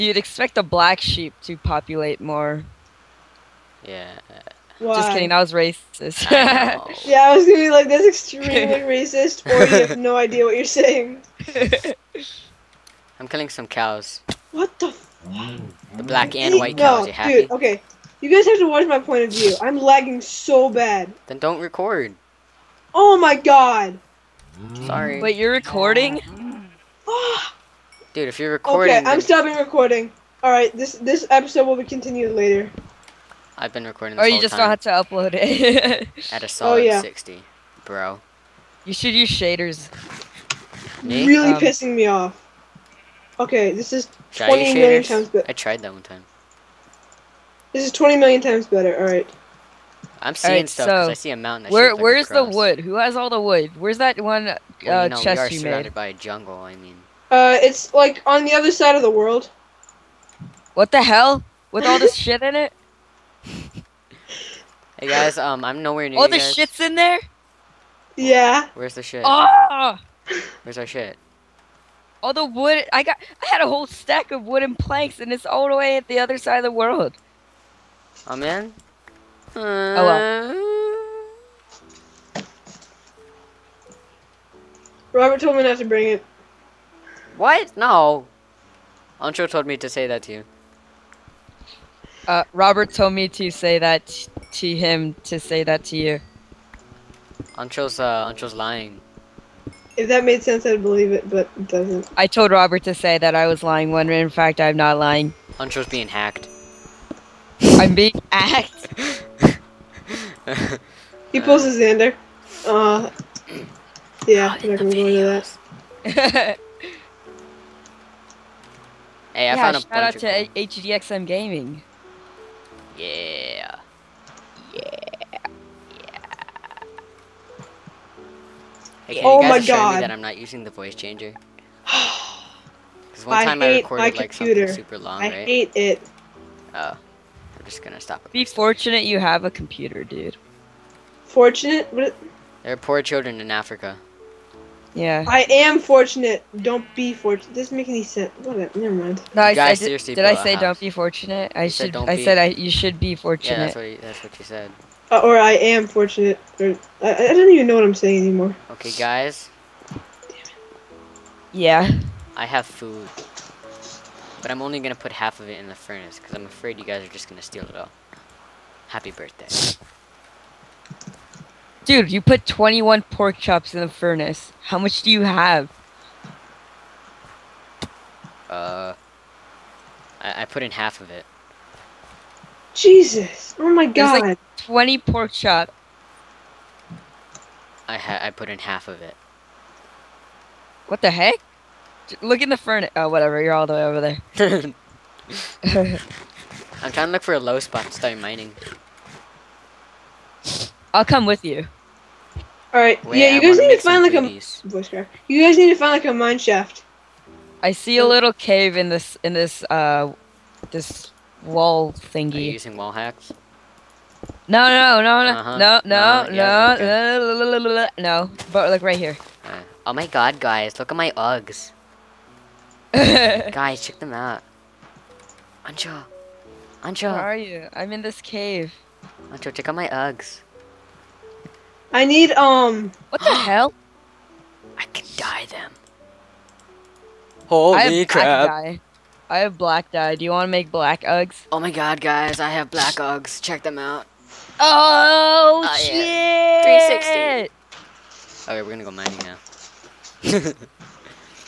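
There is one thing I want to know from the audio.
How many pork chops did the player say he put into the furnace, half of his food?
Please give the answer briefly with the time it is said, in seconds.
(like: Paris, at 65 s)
21, at 172 s.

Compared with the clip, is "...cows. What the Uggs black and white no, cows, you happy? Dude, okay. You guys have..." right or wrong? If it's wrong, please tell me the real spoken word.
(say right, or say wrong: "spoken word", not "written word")
wrong: "The", not "Uggs".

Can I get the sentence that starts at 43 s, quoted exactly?
Okay, this is 20 million times better.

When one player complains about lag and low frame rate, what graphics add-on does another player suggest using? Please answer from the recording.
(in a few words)
Shaders.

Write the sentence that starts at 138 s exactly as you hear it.
It Be fortunate you have a computer, dude.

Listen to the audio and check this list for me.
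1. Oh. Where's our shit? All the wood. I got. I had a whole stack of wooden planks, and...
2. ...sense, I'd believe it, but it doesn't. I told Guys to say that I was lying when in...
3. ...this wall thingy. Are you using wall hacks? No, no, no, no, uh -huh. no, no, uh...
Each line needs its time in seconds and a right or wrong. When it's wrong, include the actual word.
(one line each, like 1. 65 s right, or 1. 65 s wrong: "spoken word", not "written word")
1. 69 s right
2. 100 s wrong: "Robert", not "Guys"
3. 210 s right.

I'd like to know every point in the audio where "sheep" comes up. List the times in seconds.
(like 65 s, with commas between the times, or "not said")
1 s.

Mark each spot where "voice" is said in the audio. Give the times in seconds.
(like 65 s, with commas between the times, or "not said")
130 s, 204 s.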